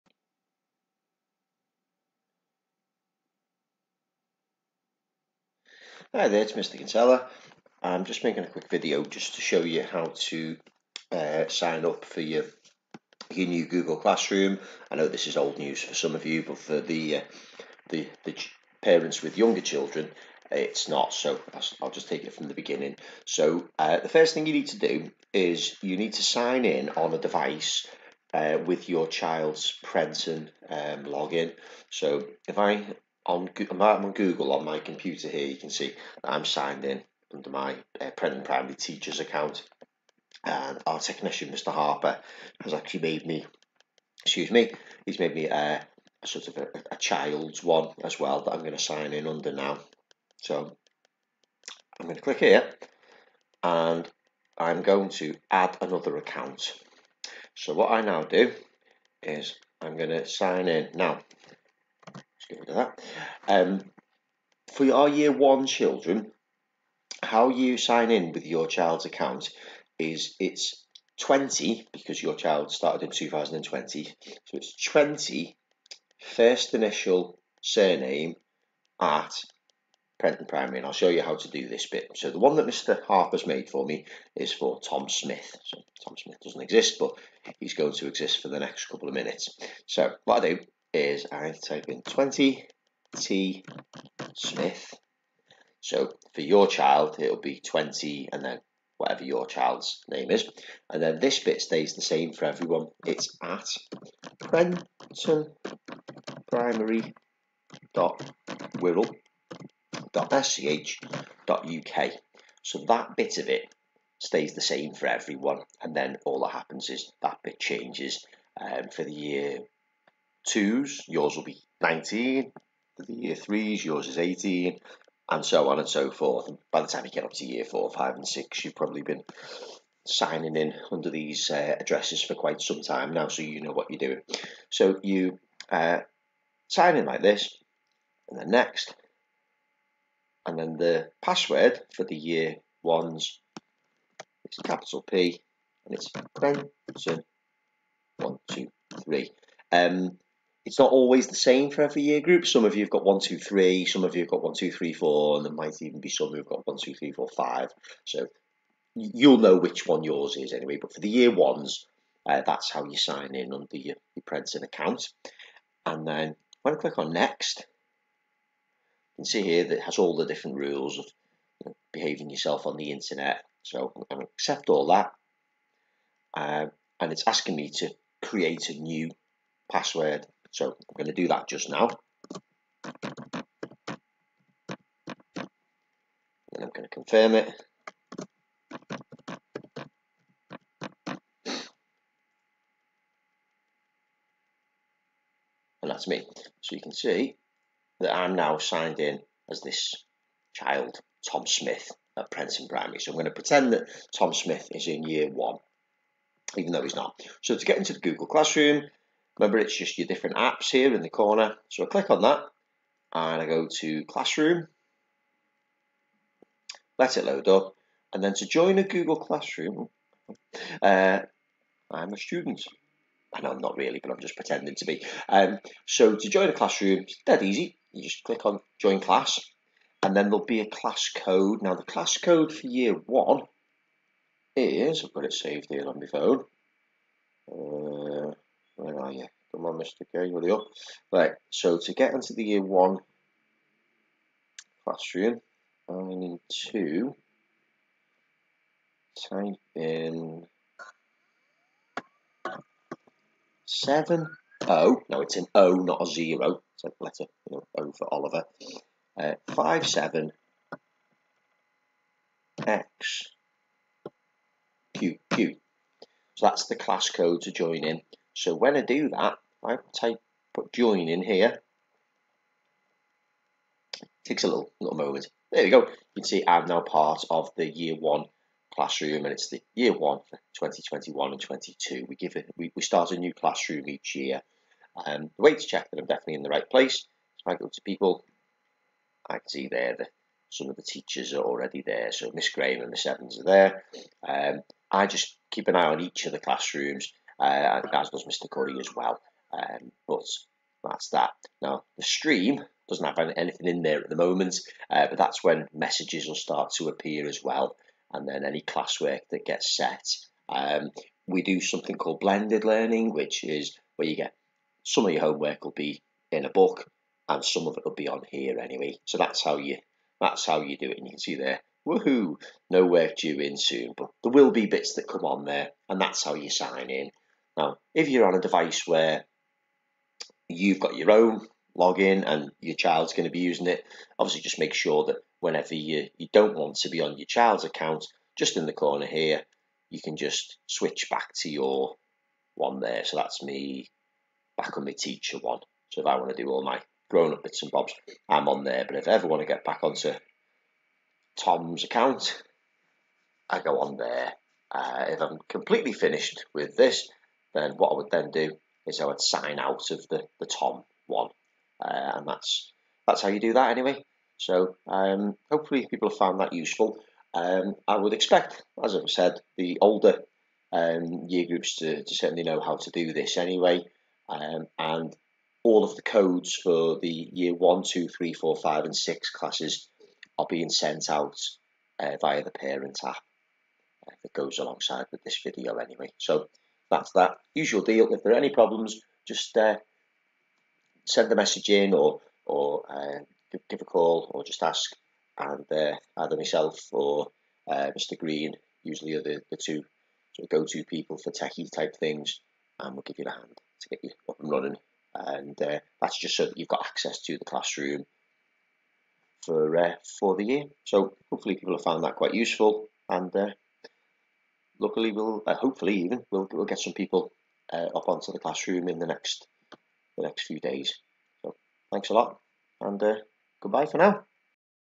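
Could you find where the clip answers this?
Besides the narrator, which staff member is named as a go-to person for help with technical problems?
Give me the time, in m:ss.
6:37.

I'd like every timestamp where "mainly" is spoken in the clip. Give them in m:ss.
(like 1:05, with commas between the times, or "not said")
not said.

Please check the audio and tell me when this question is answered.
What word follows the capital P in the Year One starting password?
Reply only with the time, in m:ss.
2:26.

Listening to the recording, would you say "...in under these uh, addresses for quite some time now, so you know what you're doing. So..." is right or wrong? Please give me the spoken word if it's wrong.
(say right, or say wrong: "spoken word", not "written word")
right.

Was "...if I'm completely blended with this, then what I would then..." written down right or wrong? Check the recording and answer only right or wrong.
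wrong.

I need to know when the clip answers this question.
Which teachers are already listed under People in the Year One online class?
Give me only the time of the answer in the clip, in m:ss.
4:52.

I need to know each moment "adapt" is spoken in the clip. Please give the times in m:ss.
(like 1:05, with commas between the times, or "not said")
not said.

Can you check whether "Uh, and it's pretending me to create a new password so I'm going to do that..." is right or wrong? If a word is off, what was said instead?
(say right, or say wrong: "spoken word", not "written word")
wrong: "asking", not "pretending".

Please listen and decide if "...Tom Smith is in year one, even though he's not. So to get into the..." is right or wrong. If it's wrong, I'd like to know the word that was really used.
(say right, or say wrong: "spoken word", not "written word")
right.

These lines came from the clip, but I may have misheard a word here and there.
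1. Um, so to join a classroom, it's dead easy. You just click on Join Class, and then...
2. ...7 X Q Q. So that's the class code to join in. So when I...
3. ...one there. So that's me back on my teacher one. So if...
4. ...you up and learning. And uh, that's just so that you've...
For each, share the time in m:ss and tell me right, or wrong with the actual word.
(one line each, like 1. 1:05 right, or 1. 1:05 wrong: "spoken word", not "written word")
1. 3:45 right
2. 4:19 right
3. 5:42 right
4. 6:44 wrong: "running", not "learning".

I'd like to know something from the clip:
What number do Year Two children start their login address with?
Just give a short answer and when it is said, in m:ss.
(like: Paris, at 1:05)
19, at 2:01.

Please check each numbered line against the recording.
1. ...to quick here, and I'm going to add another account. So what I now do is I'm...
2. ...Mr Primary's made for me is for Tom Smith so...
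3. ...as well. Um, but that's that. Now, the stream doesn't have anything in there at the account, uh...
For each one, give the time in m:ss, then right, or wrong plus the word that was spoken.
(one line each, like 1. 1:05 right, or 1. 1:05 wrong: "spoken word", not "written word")
1. 0:52 wrong: "click", not "quick"
2. 1:22 wrong: "Harper", not "Primary"
3. 4:58 wrong: "moment", not "account".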